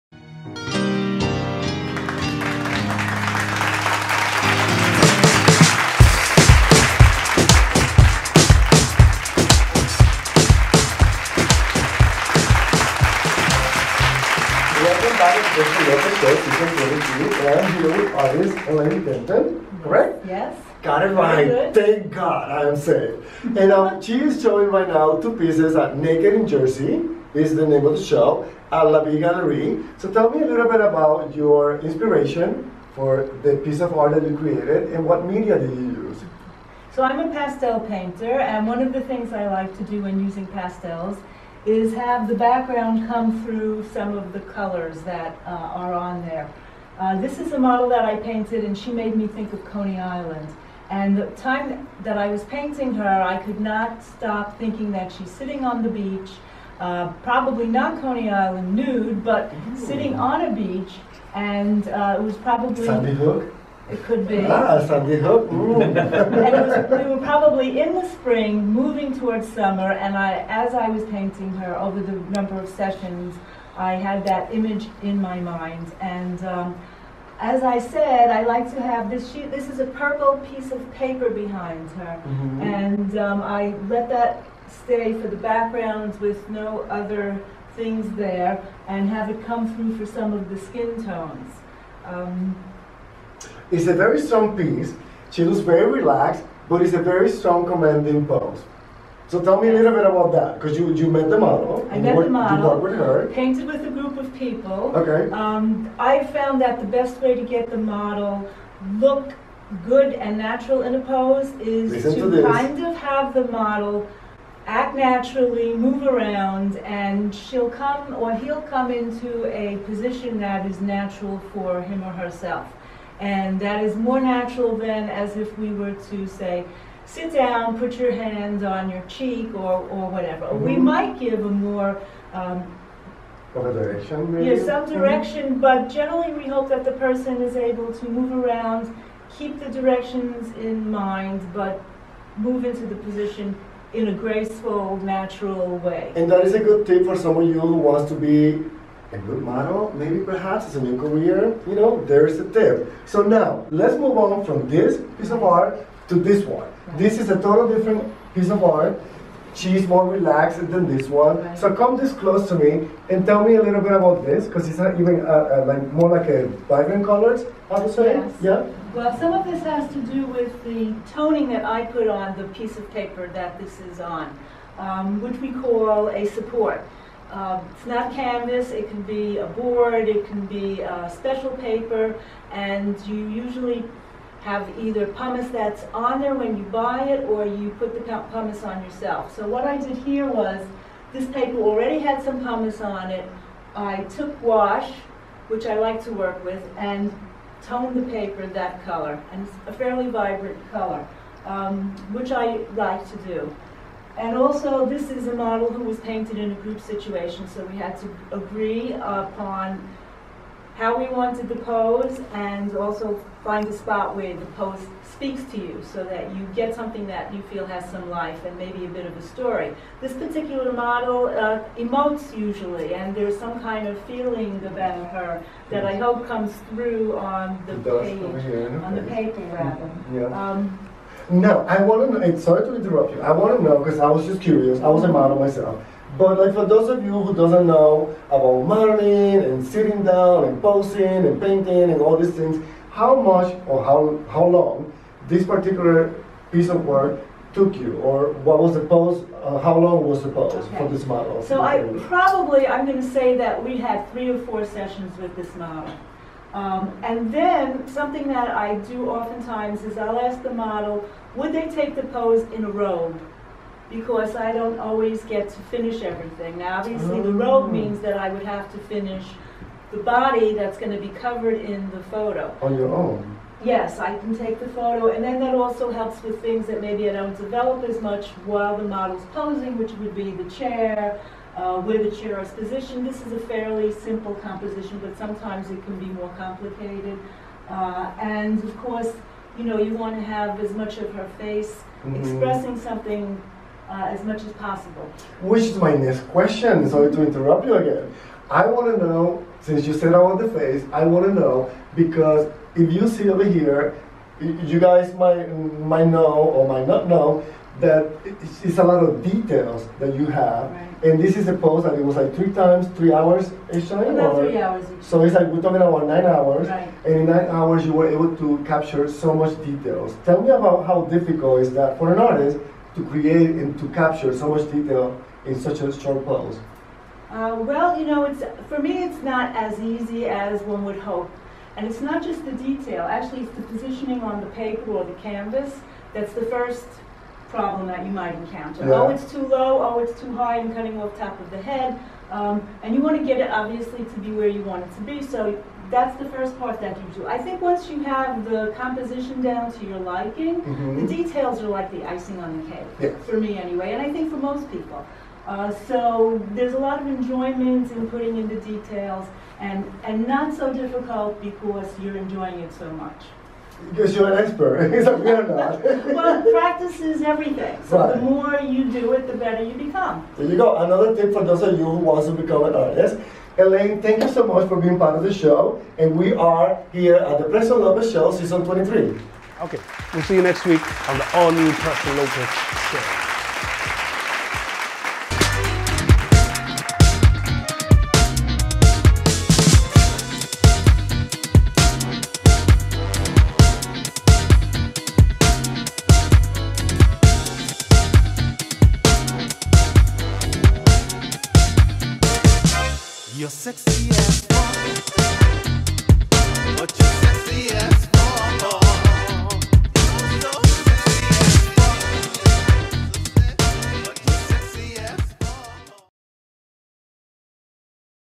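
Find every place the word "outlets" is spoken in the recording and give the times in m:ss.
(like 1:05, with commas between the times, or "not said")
not said.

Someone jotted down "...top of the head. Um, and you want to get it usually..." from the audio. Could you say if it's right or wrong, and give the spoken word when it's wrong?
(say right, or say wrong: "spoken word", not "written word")
wrong: "obviously", not "usually".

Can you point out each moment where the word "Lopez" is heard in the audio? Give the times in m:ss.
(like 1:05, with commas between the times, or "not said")
6:17, 6:22.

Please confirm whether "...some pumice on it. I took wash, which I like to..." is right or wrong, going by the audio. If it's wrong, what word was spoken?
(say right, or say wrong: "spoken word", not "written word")
right.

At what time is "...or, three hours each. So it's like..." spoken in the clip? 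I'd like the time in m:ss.
5:14.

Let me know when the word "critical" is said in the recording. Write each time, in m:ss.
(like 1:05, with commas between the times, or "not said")
not said.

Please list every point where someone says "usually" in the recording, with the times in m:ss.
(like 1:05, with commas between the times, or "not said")
3:03, 3:42.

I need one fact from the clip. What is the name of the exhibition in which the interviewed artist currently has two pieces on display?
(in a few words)
Naked in Jersey.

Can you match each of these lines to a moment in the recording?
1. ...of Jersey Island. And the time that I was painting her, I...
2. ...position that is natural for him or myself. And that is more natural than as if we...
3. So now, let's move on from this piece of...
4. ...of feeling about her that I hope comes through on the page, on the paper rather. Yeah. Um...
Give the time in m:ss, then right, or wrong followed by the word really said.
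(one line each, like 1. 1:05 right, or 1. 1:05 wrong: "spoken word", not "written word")
1. 0:49 wrong: "Coney", not "Jersey"
2. 1:59 wrong: "herself", not "myself"
3. 2:33 right
4. 3:43 right.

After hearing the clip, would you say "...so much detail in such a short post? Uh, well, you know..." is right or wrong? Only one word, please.
right.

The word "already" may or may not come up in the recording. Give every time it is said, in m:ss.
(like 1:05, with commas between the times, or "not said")
3:11.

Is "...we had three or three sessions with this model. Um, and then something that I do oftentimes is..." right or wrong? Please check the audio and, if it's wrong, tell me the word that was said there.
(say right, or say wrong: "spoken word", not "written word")
wrong: "four", not "three".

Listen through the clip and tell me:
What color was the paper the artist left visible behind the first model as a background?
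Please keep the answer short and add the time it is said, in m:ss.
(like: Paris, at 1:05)
Purple, at 1:19.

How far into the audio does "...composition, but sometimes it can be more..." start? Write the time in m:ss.
4:44.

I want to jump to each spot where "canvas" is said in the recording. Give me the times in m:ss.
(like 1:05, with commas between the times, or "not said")
2:58, 5:35.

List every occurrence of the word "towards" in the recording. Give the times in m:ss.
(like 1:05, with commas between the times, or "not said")
1:09.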